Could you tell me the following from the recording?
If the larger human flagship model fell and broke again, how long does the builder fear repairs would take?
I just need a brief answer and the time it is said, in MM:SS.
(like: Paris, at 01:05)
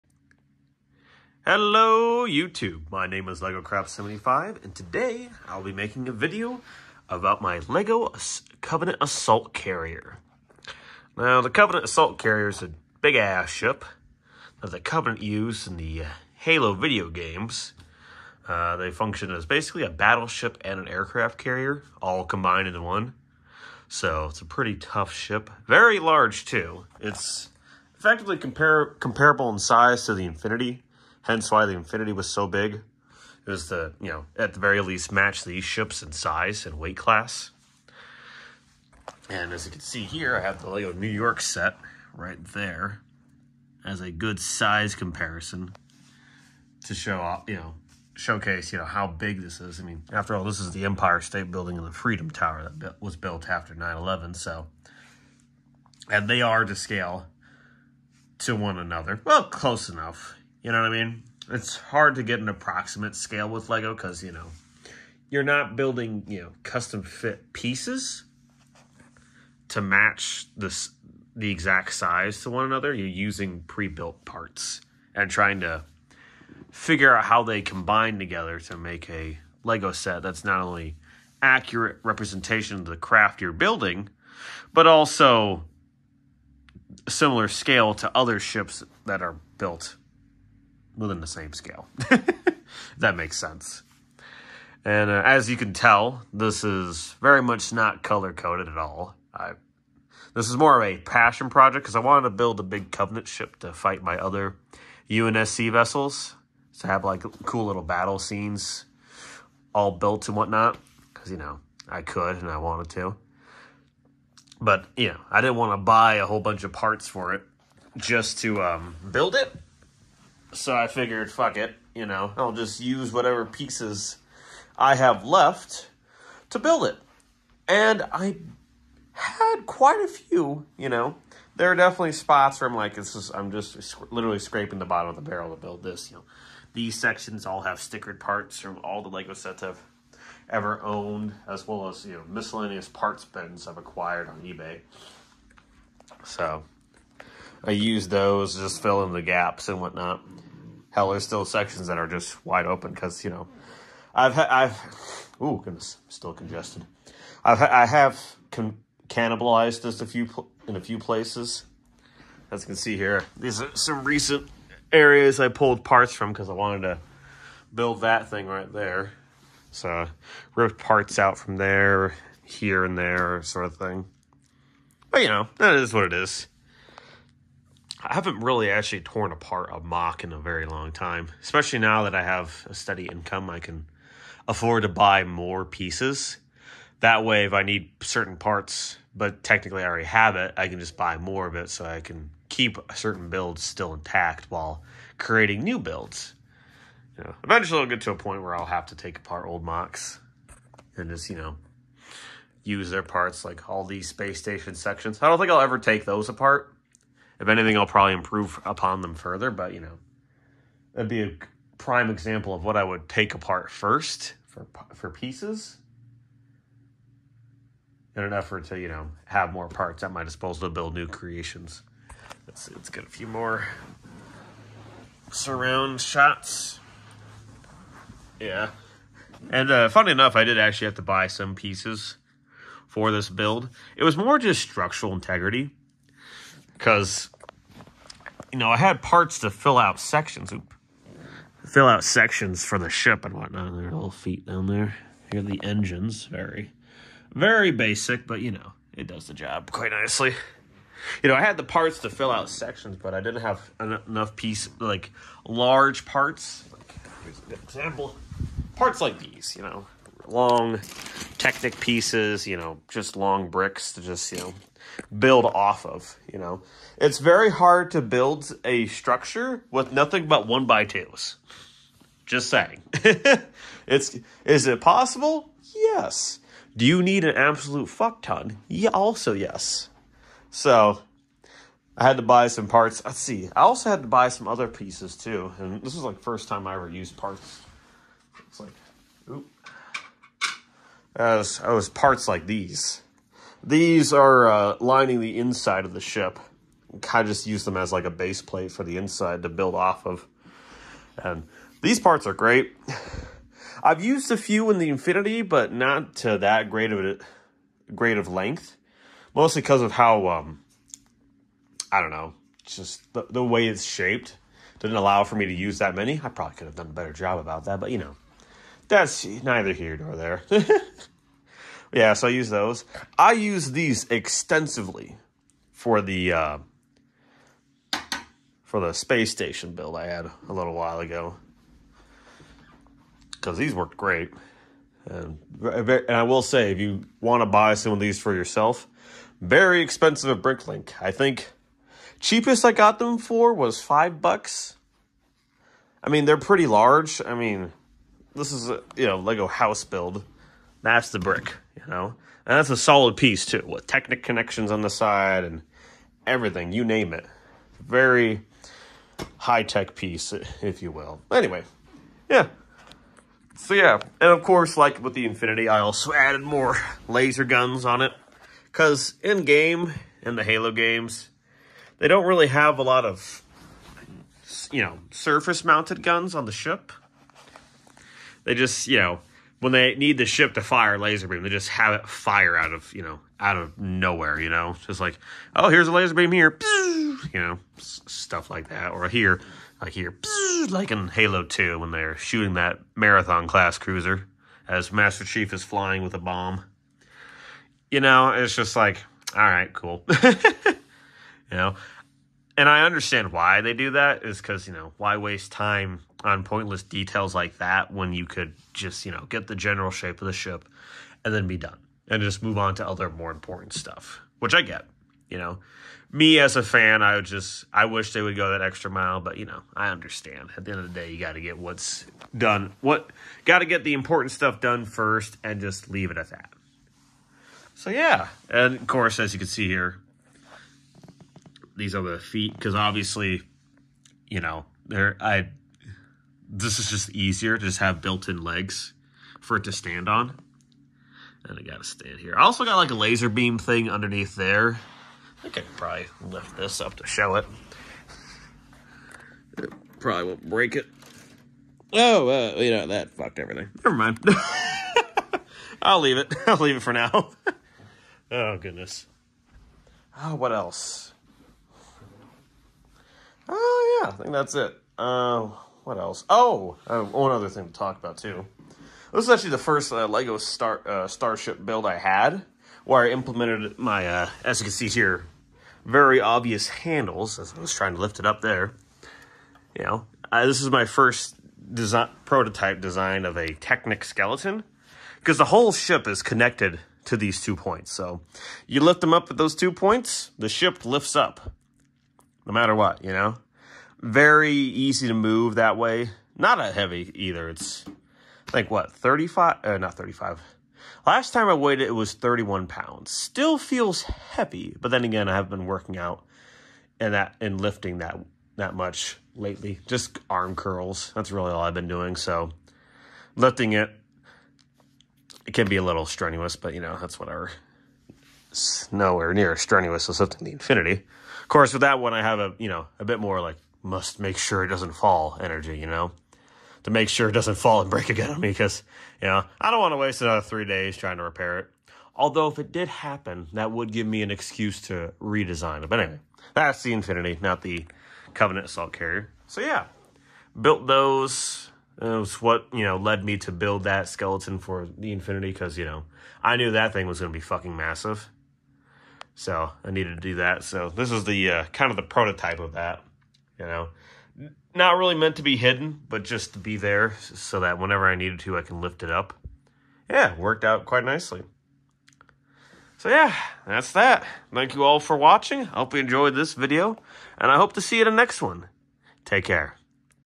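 3 days, at 08:50.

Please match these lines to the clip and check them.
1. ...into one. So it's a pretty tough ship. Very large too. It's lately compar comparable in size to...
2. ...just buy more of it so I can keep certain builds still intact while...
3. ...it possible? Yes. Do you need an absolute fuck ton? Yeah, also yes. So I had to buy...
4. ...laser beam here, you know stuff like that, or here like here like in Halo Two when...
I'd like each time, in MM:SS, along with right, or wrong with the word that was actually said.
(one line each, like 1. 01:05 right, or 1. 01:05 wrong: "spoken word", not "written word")
1. 00:22 wrong: "effectively", not "lately"
2. 03:10 right
3. 04:34 right
4. 06:25 right.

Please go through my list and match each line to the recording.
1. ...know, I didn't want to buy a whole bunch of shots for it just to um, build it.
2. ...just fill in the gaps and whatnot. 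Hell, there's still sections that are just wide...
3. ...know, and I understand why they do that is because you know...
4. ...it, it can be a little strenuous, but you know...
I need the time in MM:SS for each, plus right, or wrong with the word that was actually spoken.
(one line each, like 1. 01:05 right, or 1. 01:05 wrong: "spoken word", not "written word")
1. 01:55 wrong: "parts", not "shots"
2. 02:28 right
3. 06:41 right
4. 08:33 right.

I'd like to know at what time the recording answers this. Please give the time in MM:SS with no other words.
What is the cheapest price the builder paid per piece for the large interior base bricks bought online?
05:43.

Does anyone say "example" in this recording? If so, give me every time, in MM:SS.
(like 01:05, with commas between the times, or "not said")
03:32, 04:17.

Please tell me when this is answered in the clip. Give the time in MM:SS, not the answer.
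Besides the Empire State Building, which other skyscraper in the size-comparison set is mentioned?
00:51.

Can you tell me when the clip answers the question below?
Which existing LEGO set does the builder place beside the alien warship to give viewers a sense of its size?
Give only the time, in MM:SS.
00:40.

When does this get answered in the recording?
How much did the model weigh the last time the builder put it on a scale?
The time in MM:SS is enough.
08:22.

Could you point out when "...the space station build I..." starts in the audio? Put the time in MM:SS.
05:28.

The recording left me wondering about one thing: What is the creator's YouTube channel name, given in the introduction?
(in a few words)
LegoCraft75.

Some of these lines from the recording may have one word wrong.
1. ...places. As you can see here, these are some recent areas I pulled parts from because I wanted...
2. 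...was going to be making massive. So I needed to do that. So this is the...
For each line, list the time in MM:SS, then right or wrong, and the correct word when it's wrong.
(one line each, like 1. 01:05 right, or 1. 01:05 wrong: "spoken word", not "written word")
1. 02:40 right
2. 09:07 wrong: "fucking", not "making".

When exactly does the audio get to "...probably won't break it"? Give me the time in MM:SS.
07:29.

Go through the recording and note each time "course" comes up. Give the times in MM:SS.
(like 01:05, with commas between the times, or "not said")
06:04, 07:08, 08:41.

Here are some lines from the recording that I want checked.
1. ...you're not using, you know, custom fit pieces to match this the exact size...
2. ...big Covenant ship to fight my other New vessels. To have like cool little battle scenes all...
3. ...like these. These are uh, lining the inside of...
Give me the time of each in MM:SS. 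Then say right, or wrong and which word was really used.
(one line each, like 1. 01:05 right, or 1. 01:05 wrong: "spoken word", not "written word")
1. 01:05 wrong: "building", not "using"
2. 01:42 wrong: "UNSC", not "New"
3. 04:52 right.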